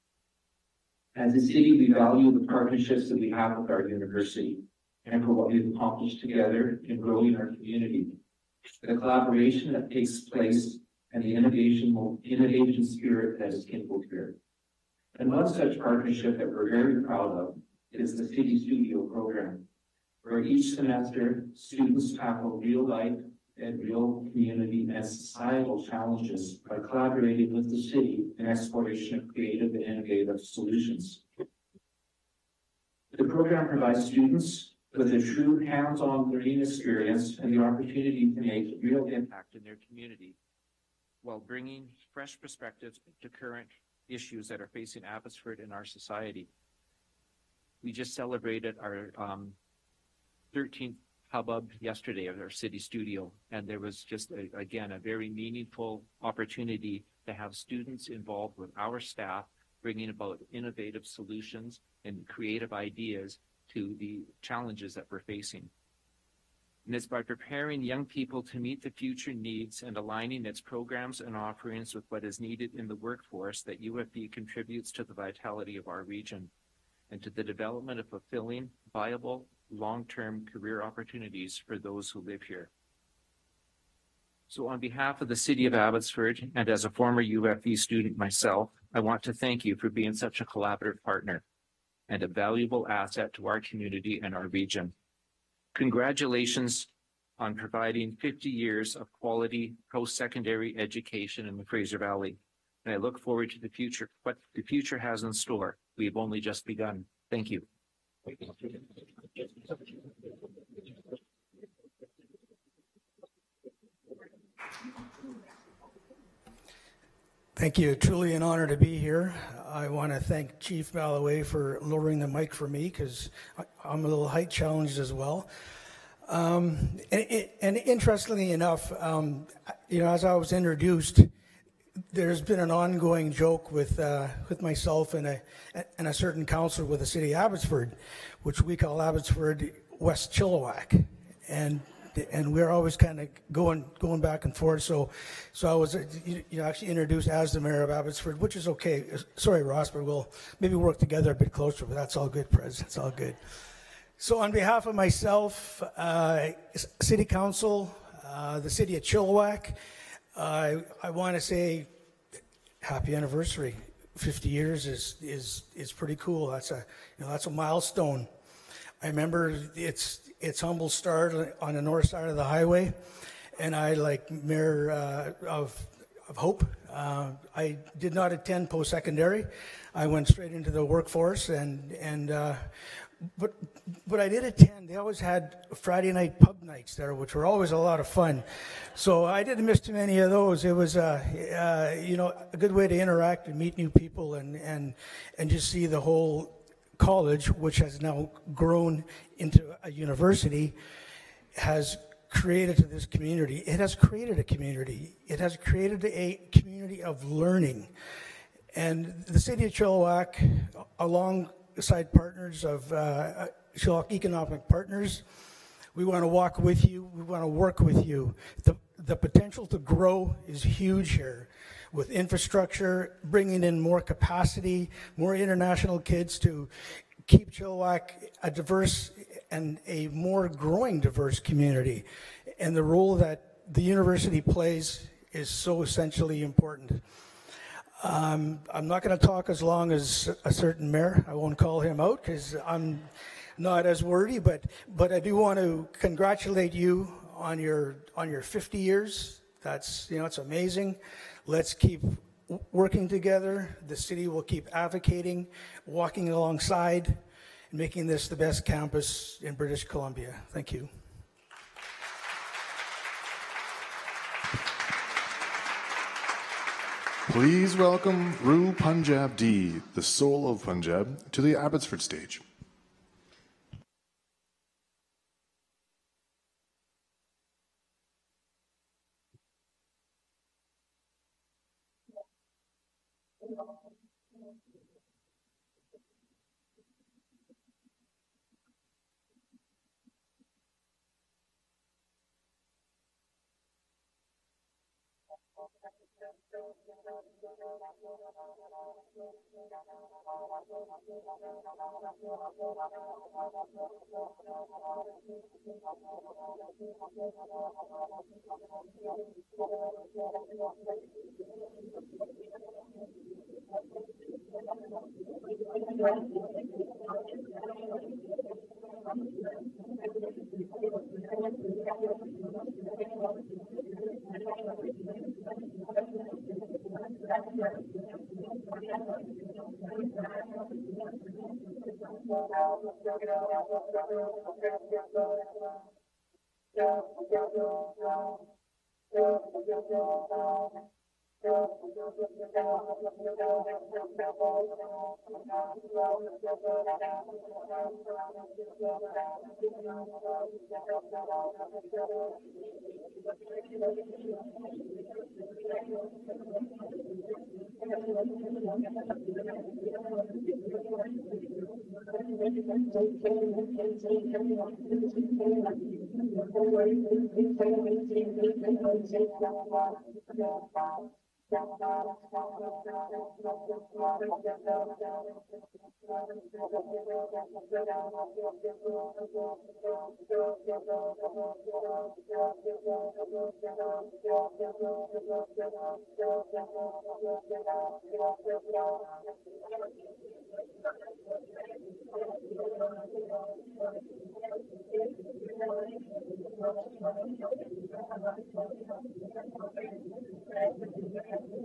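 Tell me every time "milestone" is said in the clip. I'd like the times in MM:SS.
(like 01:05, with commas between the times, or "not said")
02:47.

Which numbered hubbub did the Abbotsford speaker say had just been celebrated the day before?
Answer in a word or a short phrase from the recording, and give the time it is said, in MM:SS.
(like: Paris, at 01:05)
13th, at 00:50.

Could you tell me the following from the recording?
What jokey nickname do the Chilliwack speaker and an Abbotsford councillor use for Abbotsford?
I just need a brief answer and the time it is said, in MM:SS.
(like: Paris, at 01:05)
West Chilliwack, at 02:19.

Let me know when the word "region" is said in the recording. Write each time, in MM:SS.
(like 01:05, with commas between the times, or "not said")
01:16, 01:34.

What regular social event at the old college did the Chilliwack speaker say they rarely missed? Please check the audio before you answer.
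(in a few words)
Friday night pub nights.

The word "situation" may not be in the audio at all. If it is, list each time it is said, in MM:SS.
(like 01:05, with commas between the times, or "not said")
not said.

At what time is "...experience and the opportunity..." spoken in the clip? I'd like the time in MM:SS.
00:36.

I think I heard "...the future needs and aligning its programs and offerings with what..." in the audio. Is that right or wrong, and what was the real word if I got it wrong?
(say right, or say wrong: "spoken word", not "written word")
right.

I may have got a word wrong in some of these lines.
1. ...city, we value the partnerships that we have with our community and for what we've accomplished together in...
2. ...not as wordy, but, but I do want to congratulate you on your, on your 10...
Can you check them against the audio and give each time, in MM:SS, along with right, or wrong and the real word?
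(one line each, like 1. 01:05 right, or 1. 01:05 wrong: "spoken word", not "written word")
1. 00:01 wrong: "university", not "community"
2. 04:03 wrong: "50", not "10".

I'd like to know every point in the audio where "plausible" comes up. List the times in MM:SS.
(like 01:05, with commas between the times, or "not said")
not said.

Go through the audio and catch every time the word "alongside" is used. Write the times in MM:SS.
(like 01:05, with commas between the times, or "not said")
03:30, 04:16.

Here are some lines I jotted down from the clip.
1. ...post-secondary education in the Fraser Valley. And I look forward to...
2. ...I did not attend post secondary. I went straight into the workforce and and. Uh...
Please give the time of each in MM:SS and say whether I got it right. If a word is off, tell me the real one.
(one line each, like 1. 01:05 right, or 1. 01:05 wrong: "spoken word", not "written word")
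1. 01:39 right
2. 02:57 right.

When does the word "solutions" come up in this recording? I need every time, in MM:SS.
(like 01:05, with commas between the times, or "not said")
00:30, 01:01.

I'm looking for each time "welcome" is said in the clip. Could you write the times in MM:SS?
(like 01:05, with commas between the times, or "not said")
04:27.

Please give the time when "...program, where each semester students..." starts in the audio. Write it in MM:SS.
00:19.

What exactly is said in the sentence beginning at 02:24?
So, so I was you know actually introduced as the mayor of Abbotsford, which is okay.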